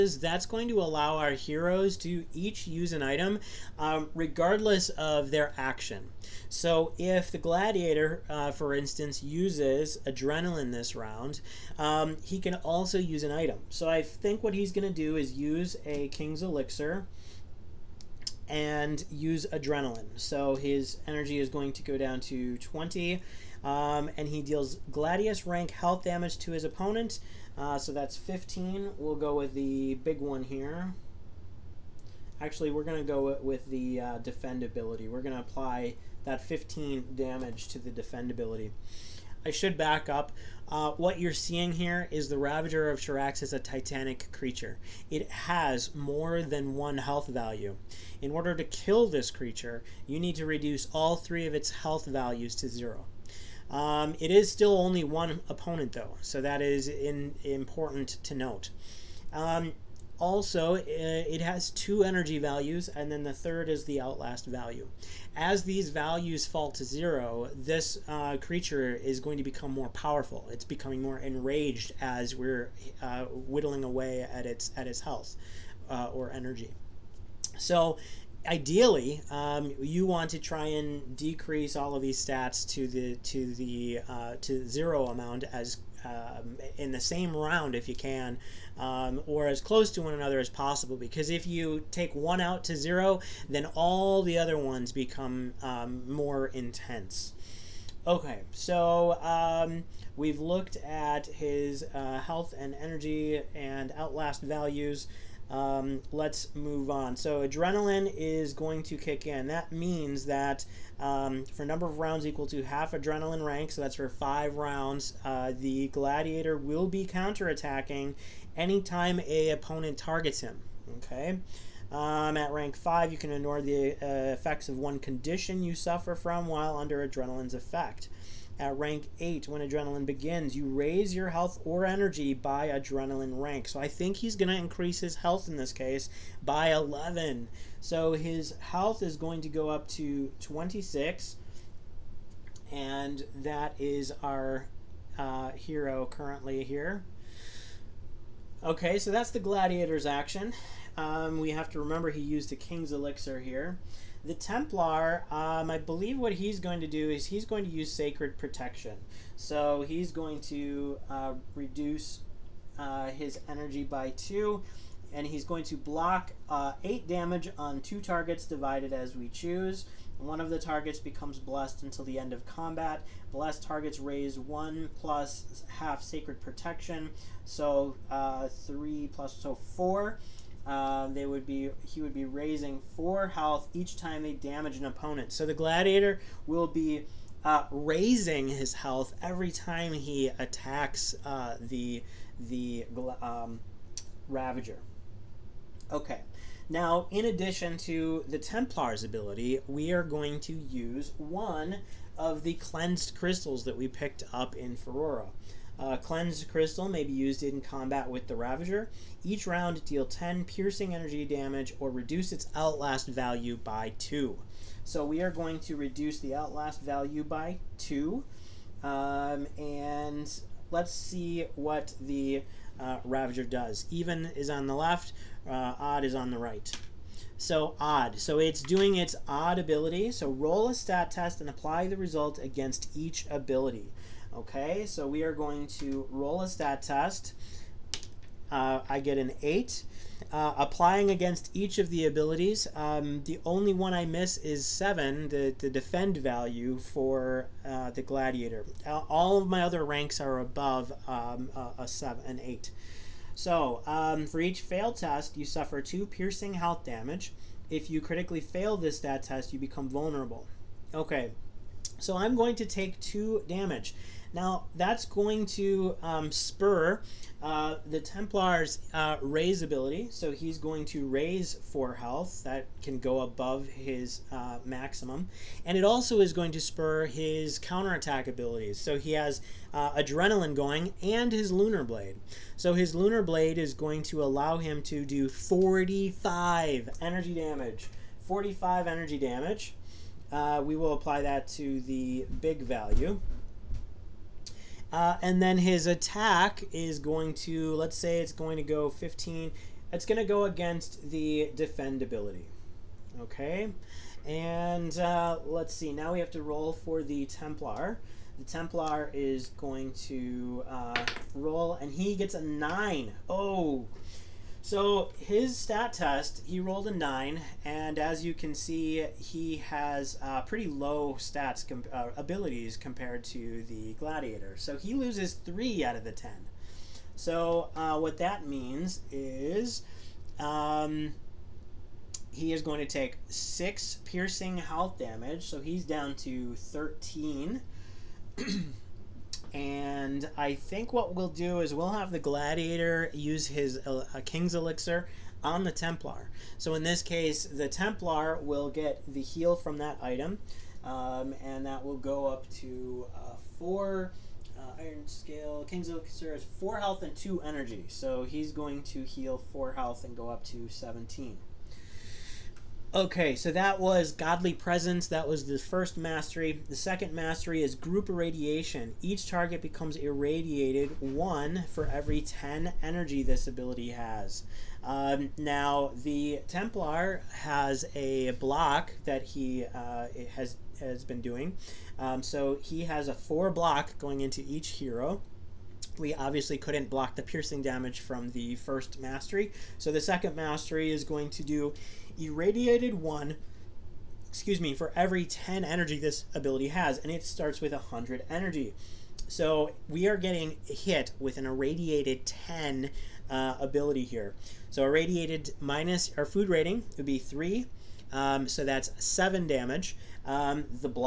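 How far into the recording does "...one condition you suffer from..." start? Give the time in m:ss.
2:04.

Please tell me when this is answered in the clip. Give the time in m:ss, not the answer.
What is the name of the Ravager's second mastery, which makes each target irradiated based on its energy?
6:07.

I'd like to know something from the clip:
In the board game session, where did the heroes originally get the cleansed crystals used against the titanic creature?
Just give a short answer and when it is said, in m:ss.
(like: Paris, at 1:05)
Phorora, at 3:24.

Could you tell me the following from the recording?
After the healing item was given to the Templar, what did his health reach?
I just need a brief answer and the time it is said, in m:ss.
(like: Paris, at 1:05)
17, at 6:00.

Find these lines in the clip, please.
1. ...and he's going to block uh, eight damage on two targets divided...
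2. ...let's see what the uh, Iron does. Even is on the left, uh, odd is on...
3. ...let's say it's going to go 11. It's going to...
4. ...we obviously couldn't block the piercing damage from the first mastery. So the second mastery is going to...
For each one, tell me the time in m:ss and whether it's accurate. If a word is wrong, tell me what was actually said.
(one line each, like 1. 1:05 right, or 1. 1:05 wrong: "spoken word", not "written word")
1. 2:45 right
2. 3:40 wrong: "Ravager", not "Iron"
3. 4:57 wrong: "15", not "11"
4. 6:25 right.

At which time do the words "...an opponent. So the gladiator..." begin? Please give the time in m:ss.
3:04.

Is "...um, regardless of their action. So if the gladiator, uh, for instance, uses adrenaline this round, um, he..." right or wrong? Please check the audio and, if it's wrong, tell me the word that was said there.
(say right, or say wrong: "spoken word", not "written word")
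right.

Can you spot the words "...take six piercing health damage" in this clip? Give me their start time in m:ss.
5:32.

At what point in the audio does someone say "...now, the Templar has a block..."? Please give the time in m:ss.
6:15.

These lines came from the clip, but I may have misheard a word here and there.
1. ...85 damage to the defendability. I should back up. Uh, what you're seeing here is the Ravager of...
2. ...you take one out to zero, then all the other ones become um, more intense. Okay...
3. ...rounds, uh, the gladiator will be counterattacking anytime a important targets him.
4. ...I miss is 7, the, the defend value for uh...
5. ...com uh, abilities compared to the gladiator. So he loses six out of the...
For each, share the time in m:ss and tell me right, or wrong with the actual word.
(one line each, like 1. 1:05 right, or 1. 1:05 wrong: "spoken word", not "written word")
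1. 0:36 wrong: "15", not "85"
2. 1:31 right
3. 1:54 wrong: "opponent", not "important"
4. 4:03 right
5. 5:21 wrong: "three", not "six".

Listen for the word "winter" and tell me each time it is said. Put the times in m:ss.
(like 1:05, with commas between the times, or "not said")
not said.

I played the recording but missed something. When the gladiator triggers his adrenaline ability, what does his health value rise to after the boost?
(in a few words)
26.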